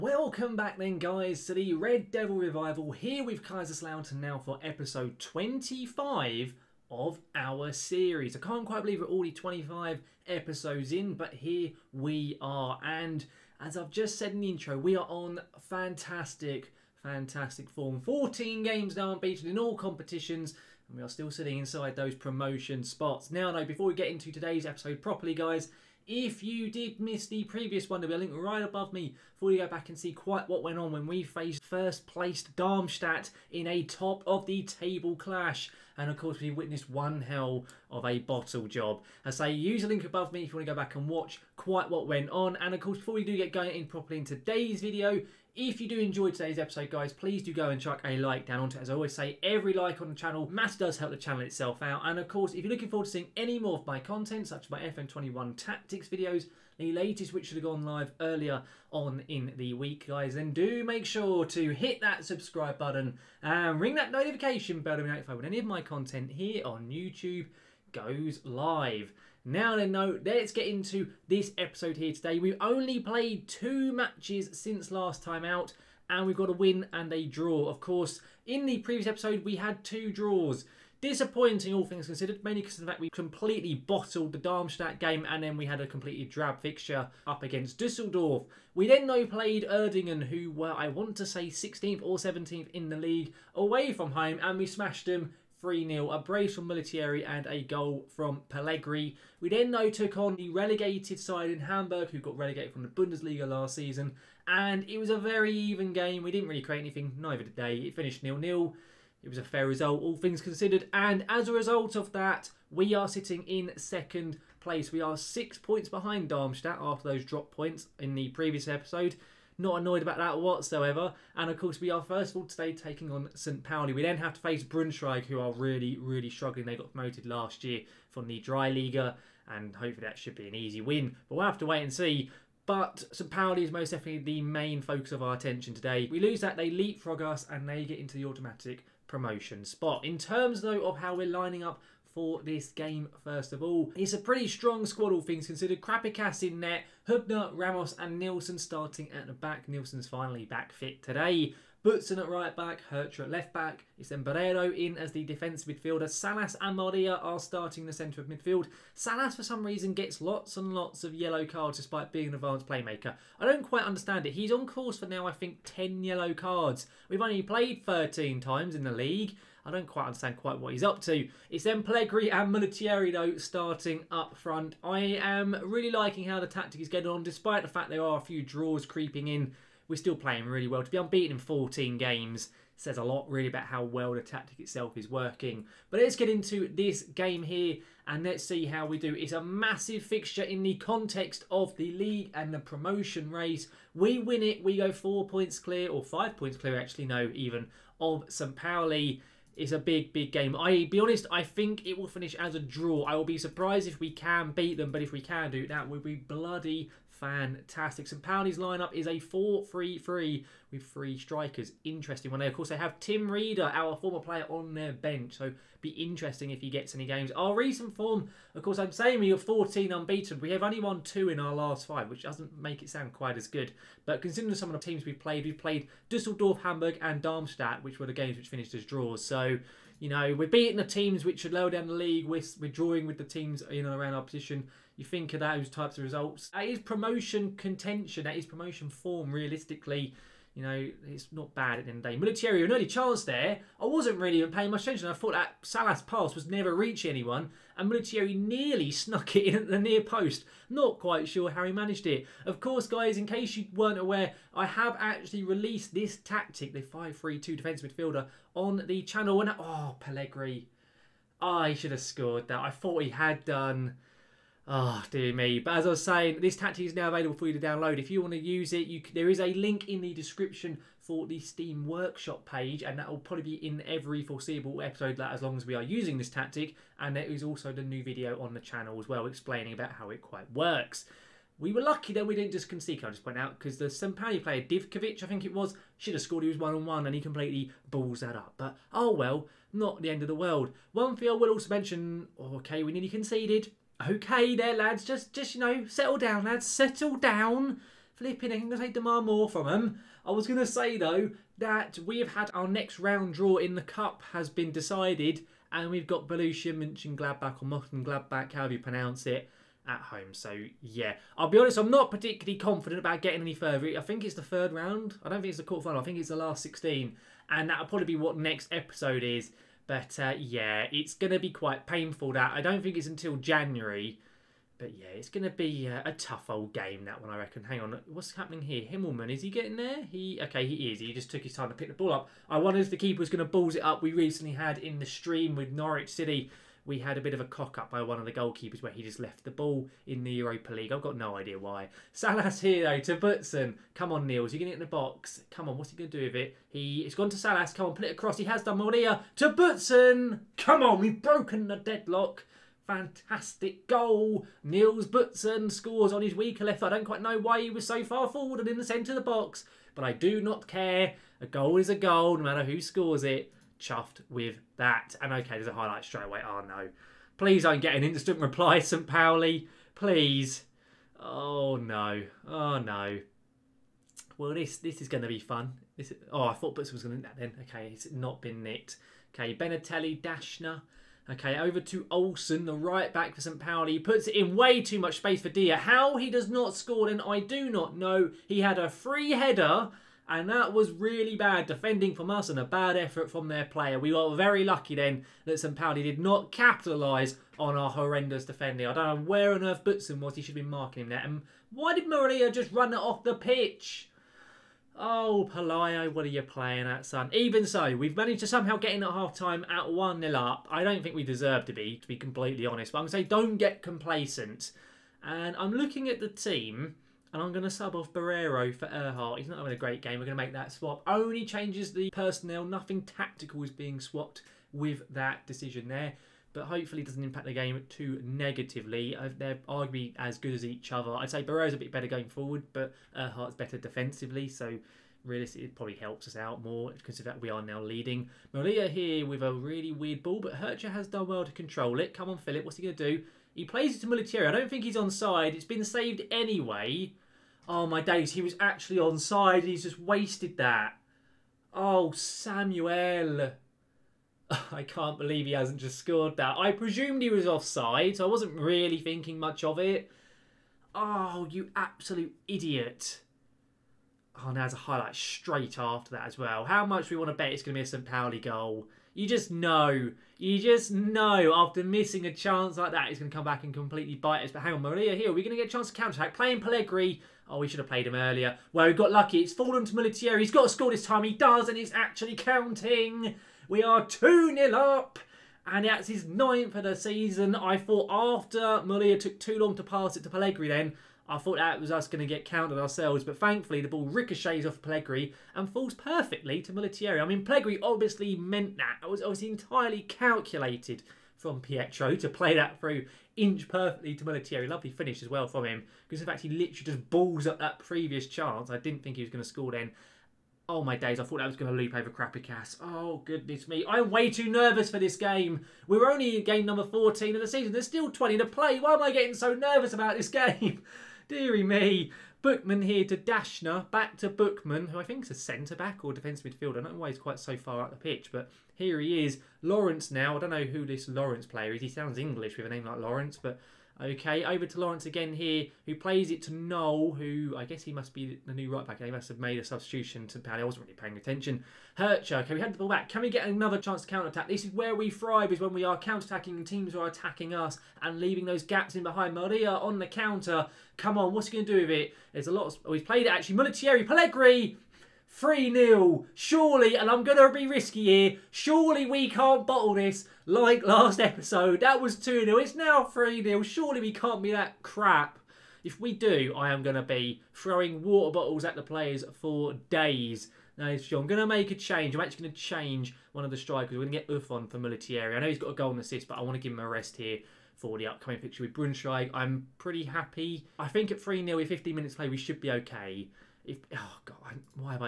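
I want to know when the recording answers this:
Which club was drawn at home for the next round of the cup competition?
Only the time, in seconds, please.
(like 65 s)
306 s.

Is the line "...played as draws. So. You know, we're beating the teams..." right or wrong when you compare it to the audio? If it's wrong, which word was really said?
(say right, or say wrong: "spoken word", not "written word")
wrong: "finished", not "played".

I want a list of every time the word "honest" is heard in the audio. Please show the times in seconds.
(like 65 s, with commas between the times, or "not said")
201 s, 311 s, 412 s.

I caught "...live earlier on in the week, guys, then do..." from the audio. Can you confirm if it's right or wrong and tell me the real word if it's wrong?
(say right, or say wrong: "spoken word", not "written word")
right.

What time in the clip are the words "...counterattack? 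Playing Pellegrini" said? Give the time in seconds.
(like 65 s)
475 s.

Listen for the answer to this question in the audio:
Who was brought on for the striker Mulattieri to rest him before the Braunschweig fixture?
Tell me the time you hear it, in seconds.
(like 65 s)
574 s.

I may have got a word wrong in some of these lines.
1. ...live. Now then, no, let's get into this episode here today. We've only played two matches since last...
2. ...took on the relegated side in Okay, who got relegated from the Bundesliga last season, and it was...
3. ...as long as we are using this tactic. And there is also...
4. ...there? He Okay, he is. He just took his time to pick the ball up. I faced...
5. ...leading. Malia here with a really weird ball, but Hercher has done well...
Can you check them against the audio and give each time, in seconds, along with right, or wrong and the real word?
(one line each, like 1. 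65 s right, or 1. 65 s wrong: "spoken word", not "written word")
1. 68 s right
2. 99 s wrong: "Hamburg", not "Okay"
3. 275 s right
4. 329 s wrong: "wondered", not "faced"
5. 437 s right.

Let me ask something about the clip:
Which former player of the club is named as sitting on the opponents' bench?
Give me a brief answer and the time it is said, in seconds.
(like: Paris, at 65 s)
Tim Rieder, at 212 s.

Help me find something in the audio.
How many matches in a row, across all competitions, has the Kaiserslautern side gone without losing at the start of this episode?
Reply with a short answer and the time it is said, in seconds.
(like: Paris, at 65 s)
14, at 18 s.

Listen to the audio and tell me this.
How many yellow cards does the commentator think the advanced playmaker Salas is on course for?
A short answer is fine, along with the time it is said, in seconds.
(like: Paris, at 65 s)
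10, at 165 s.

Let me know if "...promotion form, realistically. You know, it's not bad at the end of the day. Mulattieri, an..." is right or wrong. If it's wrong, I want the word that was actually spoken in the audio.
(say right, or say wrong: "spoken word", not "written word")
right.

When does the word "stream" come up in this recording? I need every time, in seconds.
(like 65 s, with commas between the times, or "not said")
335 s.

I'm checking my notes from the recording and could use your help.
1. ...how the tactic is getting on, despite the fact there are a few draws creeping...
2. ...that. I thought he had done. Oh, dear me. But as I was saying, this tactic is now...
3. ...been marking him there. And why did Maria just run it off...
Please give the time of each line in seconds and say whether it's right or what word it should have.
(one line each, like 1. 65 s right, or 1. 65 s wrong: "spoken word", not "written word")
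1. 176 s right
2. 262 s right
3. 400 s right.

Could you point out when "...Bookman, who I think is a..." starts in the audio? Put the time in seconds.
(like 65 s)
524 s.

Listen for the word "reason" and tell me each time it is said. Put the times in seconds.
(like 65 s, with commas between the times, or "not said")
159 s.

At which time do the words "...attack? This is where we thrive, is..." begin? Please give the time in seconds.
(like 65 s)
544 s.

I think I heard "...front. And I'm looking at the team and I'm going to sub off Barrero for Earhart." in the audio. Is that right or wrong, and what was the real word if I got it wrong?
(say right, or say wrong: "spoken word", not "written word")
wrong: "complacent", not "front".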